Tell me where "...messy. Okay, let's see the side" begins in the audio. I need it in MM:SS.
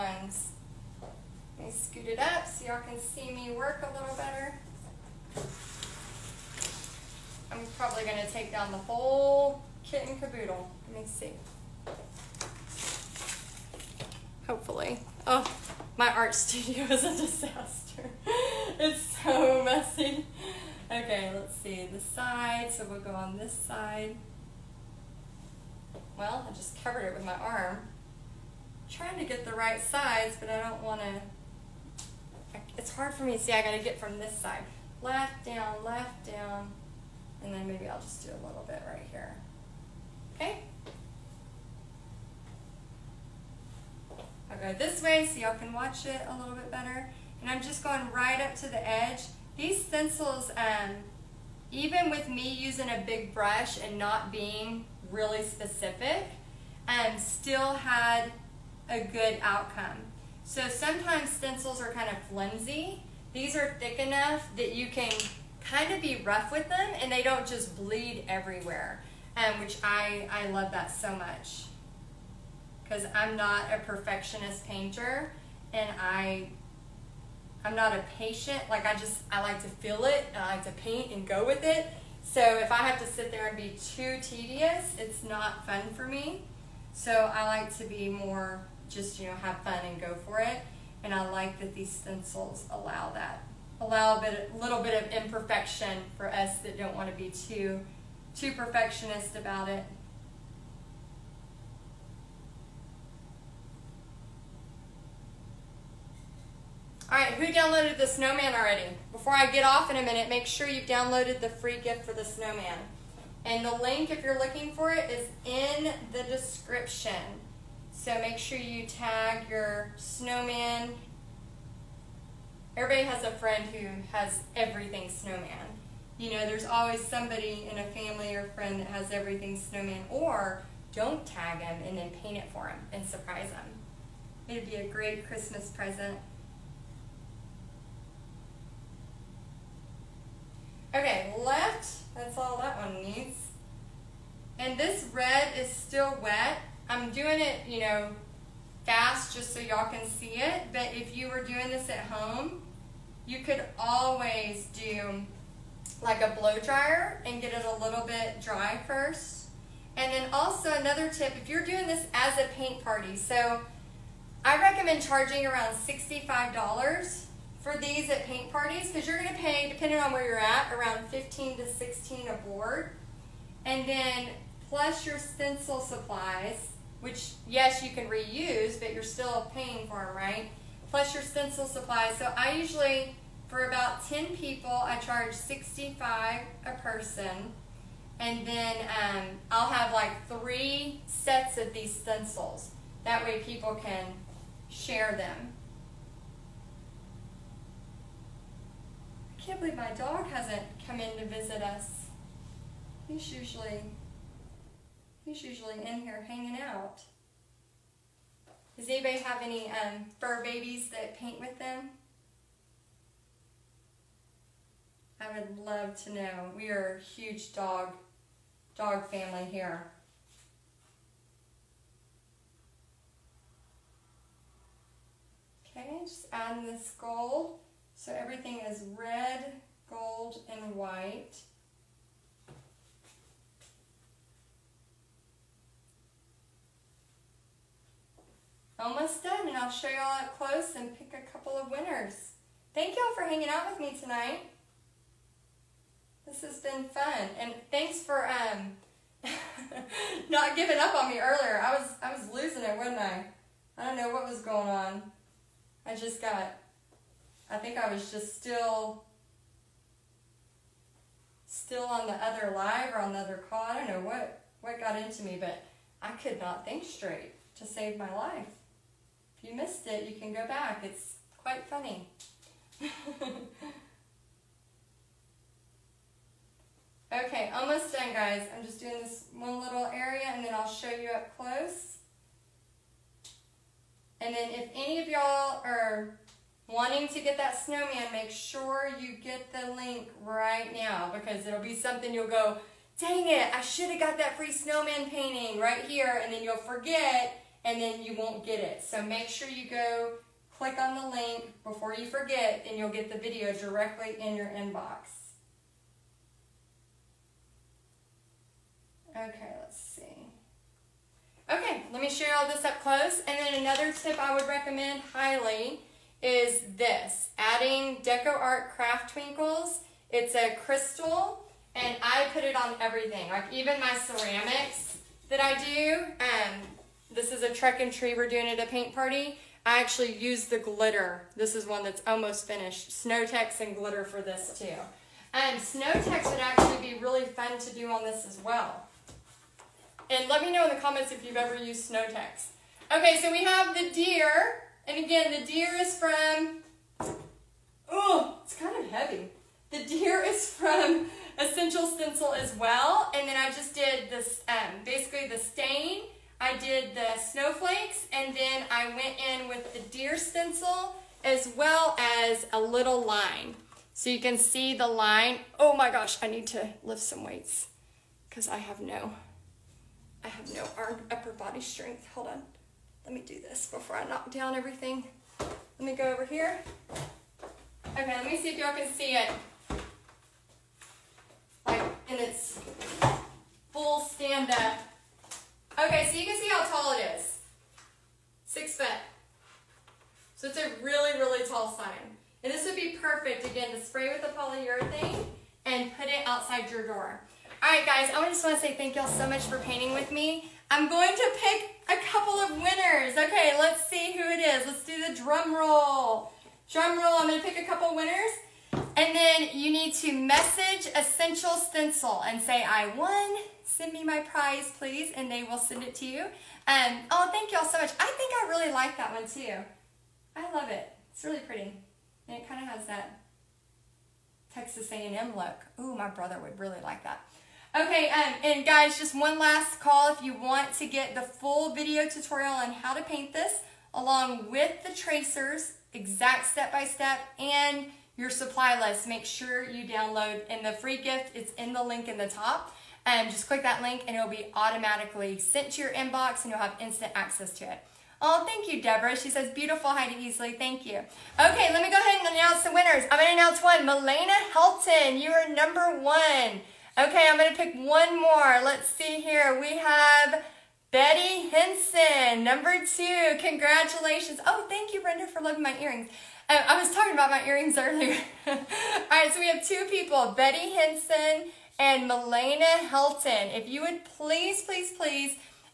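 00:19.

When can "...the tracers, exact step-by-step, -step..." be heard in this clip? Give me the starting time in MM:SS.
07:14.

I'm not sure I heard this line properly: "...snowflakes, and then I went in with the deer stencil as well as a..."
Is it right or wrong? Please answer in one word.
right.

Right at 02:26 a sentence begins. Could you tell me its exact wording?
I'm doing it, you know, fast just so y'all can see it.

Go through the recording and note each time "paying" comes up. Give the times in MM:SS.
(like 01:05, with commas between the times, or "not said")
02:59.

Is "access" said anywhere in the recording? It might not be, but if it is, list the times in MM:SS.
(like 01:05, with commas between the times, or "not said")
07:27.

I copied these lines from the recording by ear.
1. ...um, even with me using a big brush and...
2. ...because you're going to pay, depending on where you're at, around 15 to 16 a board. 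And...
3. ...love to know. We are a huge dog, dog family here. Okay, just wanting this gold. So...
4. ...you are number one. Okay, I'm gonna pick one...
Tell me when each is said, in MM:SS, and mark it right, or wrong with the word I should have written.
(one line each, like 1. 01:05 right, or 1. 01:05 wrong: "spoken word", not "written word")
1. 00:50 right
2. 02:48 right
3. 03:35 wrong: "adding", not "wanting"
4. 07:35 right.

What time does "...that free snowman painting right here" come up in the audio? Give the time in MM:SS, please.
04:54.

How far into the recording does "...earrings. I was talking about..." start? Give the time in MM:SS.
07:45.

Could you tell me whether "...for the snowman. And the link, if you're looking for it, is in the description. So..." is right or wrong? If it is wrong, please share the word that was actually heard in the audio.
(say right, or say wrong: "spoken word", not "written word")
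right.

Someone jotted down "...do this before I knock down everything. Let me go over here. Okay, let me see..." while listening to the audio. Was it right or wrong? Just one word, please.
right.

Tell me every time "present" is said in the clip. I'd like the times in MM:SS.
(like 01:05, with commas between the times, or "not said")
02:15.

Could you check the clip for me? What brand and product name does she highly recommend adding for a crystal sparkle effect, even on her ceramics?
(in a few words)
DecoArt Craft Twinkles.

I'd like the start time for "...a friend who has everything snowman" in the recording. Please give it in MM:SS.
02:03.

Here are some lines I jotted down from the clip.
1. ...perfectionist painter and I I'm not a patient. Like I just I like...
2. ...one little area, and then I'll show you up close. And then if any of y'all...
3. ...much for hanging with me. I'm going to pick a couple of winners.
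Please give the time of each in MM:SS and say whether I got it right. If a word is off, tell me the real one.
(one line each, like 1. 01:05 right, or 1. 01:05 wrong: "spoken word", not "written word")
1. 01:13 right
2. 04:39 right
3. 06:39 wrong: "painting", not "hanging".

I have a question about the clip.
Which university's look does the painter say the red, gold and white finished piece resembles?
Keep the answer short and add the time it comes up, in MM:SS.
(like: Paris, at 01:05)
Texas A&M, at 07:04.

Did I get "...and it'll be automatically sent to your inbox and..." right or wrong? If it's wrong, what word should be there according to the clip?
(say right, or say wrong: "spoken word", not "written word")
right.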